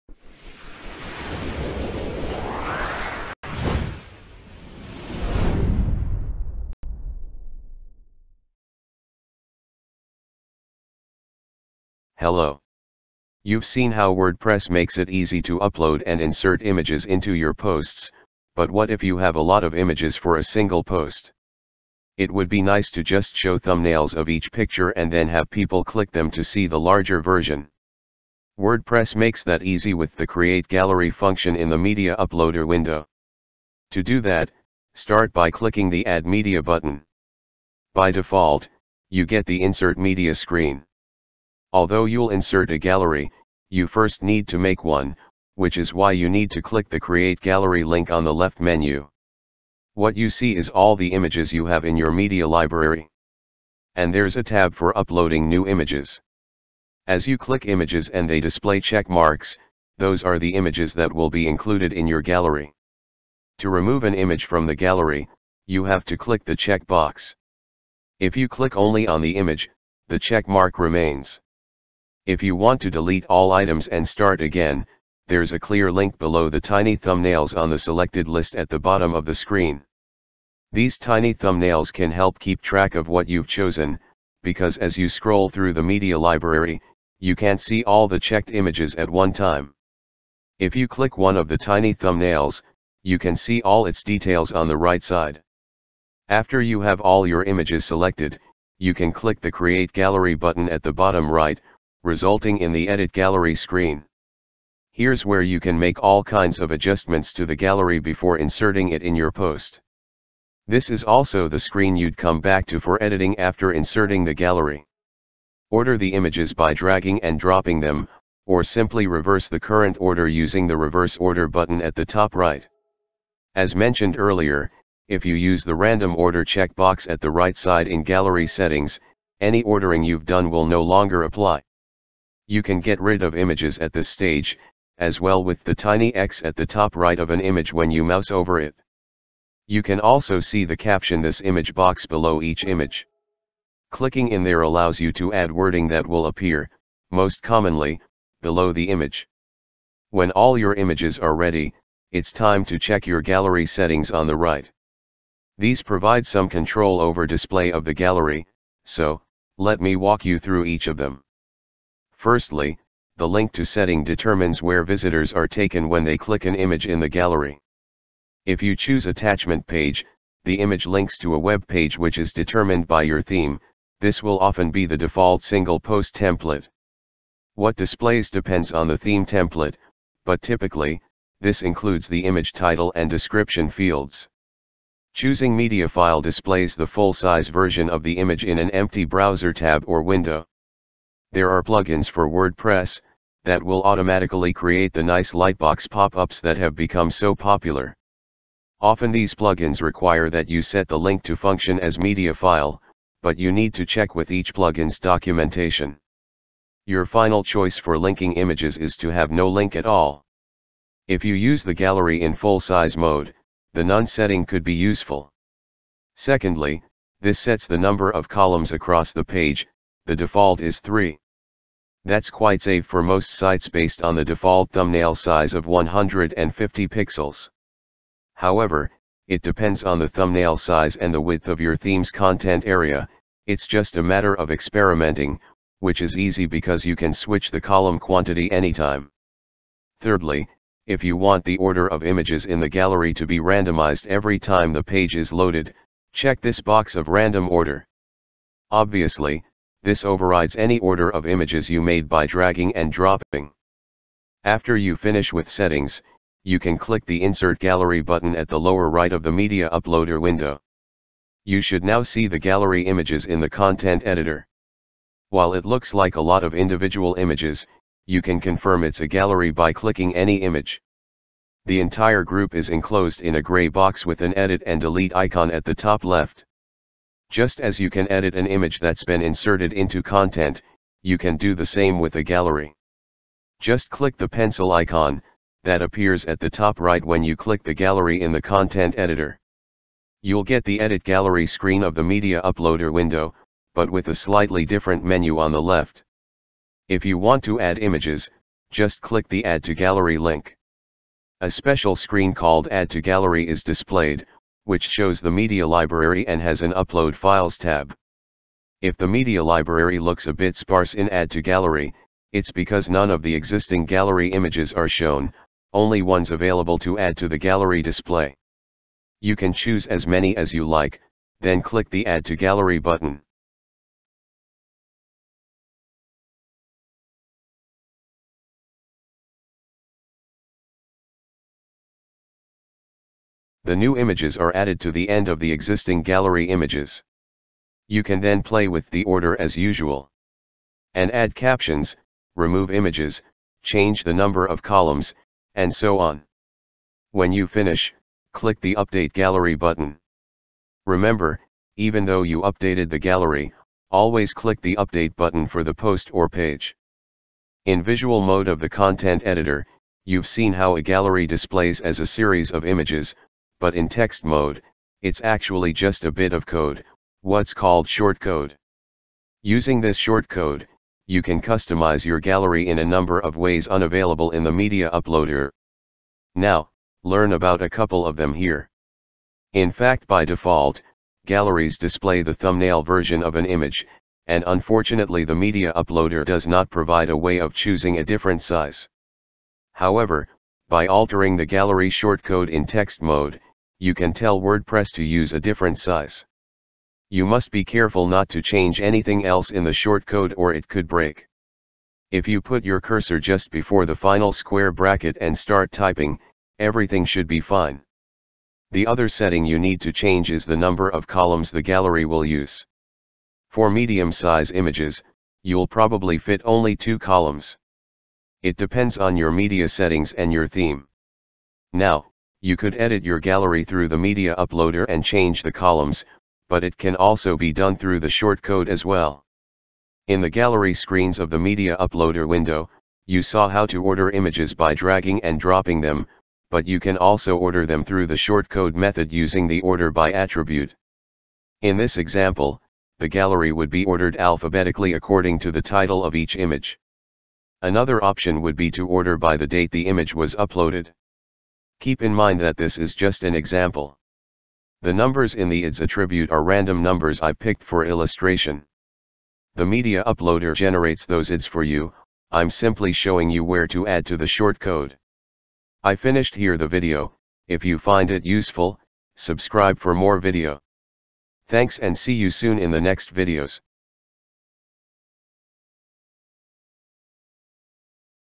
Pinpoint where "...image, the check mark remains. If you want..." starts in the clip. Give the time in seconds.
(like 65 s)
69 s.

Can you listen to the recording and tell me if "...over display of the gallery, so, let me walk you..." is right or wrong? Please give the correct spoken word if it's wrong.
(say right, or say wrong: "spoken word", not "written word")
right.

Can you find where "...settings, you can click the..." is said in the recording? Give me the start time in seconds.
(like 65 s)
255 s.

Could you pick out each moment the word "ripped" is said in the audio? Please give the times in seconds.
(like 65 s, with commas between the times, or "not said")
not said.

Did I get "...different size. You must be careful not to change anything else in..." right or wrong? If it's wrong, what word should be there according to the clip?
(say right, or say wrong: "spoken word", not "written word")
right.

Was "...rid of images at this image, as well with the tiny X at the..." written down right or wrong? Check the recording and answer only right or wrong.
wrong.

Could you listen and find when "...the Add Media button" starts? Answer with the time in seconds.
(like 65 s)
35 s.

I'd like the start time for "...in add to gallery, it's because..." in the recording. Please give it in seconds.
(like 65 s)
310 s.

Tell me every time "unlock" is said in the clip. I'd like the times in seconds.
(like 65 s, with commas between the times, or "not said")
not said.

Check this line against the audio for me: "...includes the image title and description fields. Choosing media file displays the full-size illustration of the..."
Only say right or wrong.
wrong.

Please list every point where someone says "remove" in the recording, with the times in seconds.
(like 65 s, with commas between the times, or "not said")
63 s, 342 s.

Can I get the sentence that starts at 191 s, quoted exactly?
There are plugins for WordPress, that will automatically create the nice lightbox pop-ups that have become so popular.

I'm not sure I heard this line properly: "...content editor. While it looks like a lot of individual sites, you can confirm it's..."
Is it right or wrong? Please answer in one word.
wrong.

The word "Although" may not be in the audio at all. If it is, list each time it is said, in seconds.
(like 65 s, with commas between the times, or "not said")
41 s.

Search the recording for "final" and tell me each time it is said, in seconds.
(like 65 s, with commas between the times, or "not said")
207 s, 403 s.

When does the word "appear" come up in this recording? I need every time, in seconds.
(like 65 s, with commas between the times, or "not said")
146 s, 285 s.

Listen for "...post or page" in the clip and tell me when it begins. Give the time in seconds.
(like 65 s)
355 s.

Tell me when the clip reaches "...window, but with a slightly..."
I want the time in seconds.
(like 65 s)
292 s.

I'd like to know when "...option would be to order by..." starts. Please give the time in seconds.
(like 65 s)
448 s.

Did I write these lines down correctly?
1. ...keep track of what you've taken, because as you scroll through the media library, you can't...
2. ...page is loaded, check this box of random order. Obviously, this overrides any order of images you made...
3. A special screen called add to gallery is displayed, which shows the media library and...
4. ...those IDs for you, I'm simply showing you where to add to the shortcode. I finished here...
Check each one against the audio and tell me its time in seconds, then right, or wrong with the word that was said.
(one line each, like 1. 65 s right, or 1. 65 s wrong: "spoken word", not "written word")
1. 82 s wrong: "chosen", not "taken"
2. 244 s right
3. 301 s right
4. 461 s right.